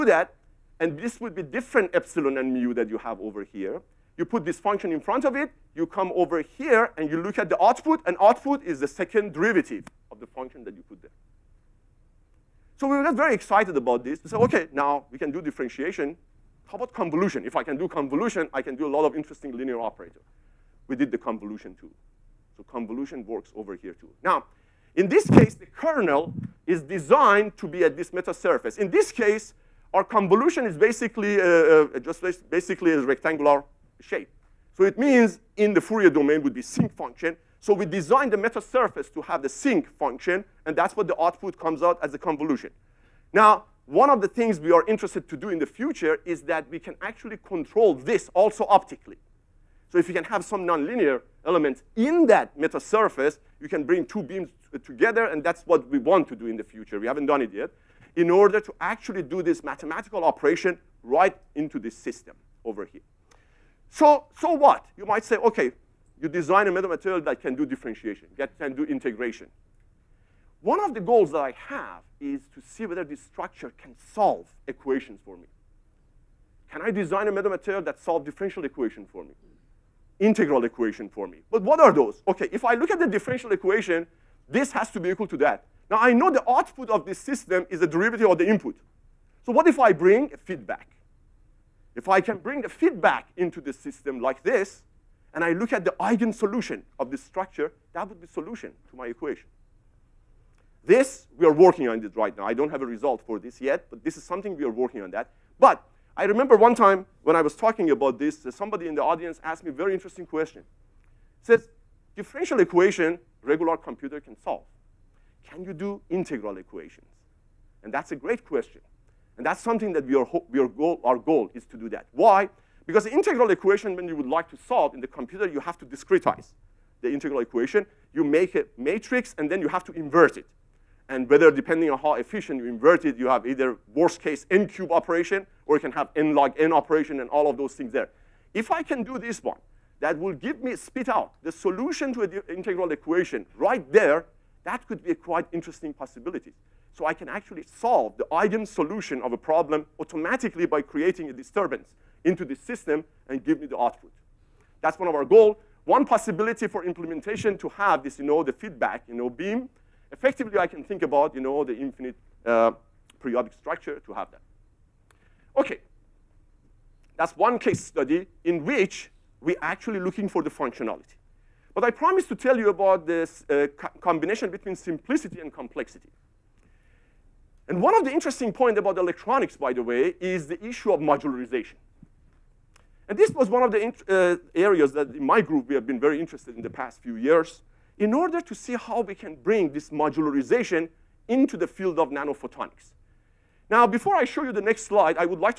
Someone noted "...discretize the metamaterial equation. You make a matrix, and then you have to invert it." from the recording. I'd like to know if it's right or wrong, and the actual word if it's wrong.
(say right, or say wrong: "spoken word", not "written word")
wrong: "integral", not "metamaterial".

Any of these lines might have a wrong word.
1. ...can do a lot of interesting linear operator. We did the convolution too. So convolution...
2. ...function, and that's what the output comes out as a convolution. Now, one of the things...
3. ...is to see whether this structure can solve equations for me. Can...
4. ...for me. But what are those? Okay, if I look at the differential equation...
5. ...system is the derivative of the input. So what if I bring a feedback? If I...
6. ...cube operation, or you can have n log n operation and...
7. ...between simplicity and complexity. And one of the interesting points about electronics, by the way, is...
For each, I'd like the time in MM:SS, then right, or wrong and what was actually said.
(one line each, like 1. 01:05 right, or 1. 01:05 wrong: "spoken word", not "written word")
1. 00:18 right
2. 00:39 right
3. 01:12 right
4. 01:21 right
5. 01:27 right
6. 02:14 right
7. 02:54 right.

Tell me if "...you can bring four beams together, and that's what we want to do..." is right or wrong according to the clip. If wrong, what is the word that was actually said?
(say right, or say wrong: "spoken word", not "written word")
wrong: "two", not "four".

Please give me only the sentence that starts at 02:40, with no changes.
Effectively, I can think about, you know, the infinite uh, periodic structure to have that.